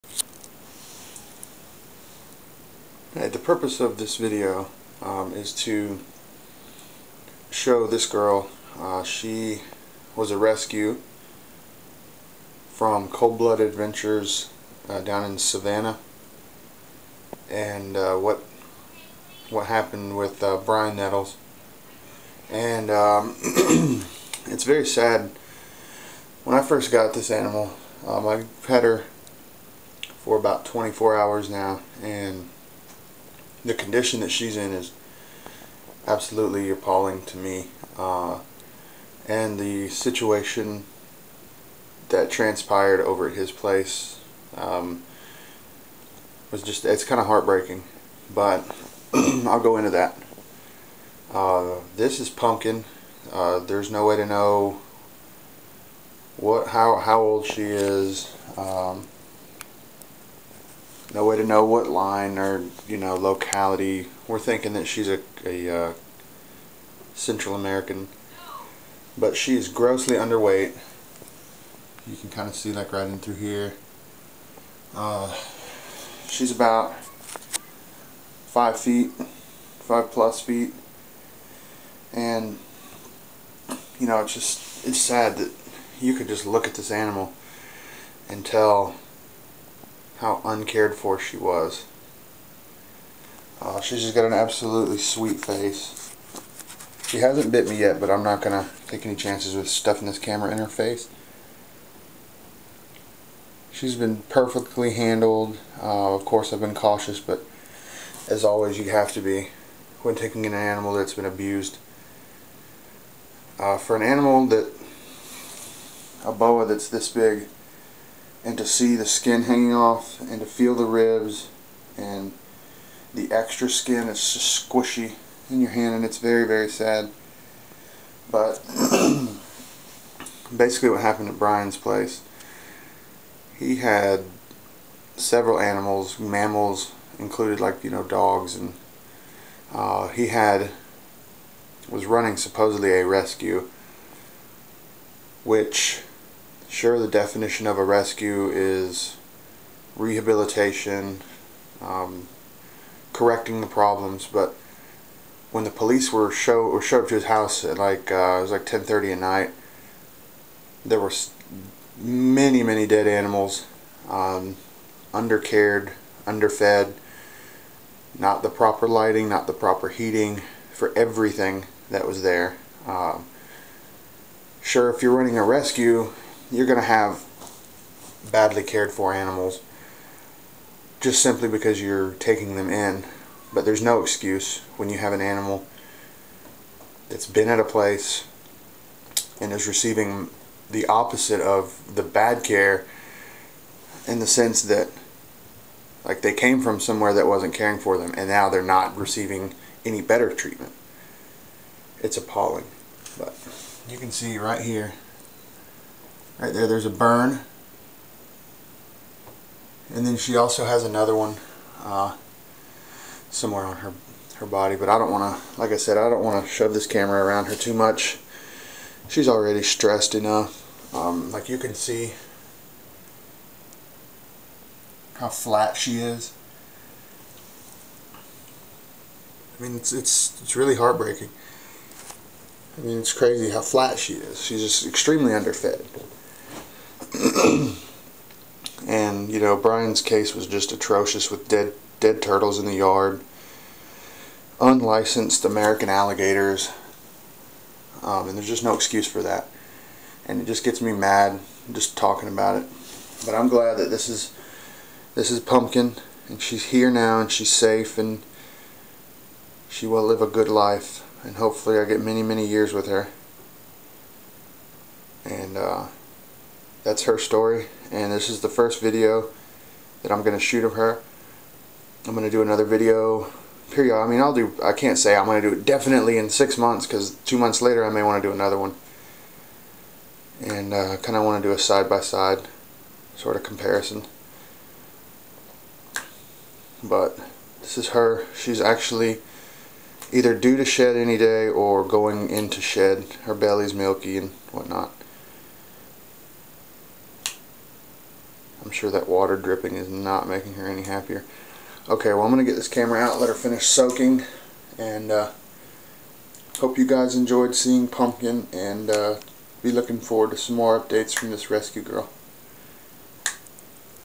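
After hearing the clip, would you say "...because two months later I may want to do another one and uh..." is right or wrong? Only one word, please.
right.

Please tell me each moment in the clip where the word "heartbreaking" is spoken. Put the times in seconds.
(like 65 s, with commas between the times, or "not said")
47 s, 230 s.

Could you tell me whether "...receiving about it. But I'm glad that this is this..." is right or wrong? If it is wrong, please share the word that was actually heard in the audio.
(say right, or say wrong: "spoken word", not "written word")
wrong: "talking", not "receiving".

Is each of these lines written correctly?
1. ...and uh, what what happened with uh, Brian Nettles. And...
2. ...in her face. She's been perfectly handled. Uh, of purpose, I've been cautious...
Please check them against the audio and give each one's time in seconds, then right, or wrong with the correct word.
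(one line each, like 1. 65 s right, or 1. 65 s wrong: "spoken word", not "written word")
1. 17 s right
2. 100 s wrong: "course", not "purpose".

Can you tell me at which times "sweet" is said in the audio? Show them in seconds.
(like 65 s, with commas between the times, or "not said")
94 s.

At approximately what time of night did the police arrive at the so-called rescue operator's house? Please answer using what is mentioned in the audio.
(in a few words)
10:30.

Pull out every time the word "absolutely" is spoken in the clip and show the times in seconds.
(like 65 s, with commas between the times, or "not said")
36 s, 94 s.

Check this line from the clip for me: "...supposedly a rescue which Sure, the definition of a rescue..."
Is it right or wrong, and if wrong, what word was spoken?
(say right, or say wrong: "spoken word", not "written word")
right.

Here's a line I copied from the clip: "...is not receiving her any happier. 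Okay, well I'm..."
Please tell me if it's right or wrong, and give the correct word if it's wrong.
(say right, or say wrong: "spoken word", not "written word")
wrong: "making", not "receiving".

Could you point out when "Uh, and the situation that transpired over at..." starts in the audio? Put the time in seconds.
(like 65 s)
37 s.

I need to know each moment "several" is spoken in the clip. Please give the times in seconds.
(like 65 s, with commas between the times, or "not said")
135 s.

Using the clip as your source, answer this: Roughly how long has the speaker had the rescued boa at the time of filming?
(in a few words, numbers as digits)
24 hours.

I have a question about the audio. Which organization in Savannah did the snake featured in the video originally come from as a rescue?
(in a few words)
Cold Blood Adventures.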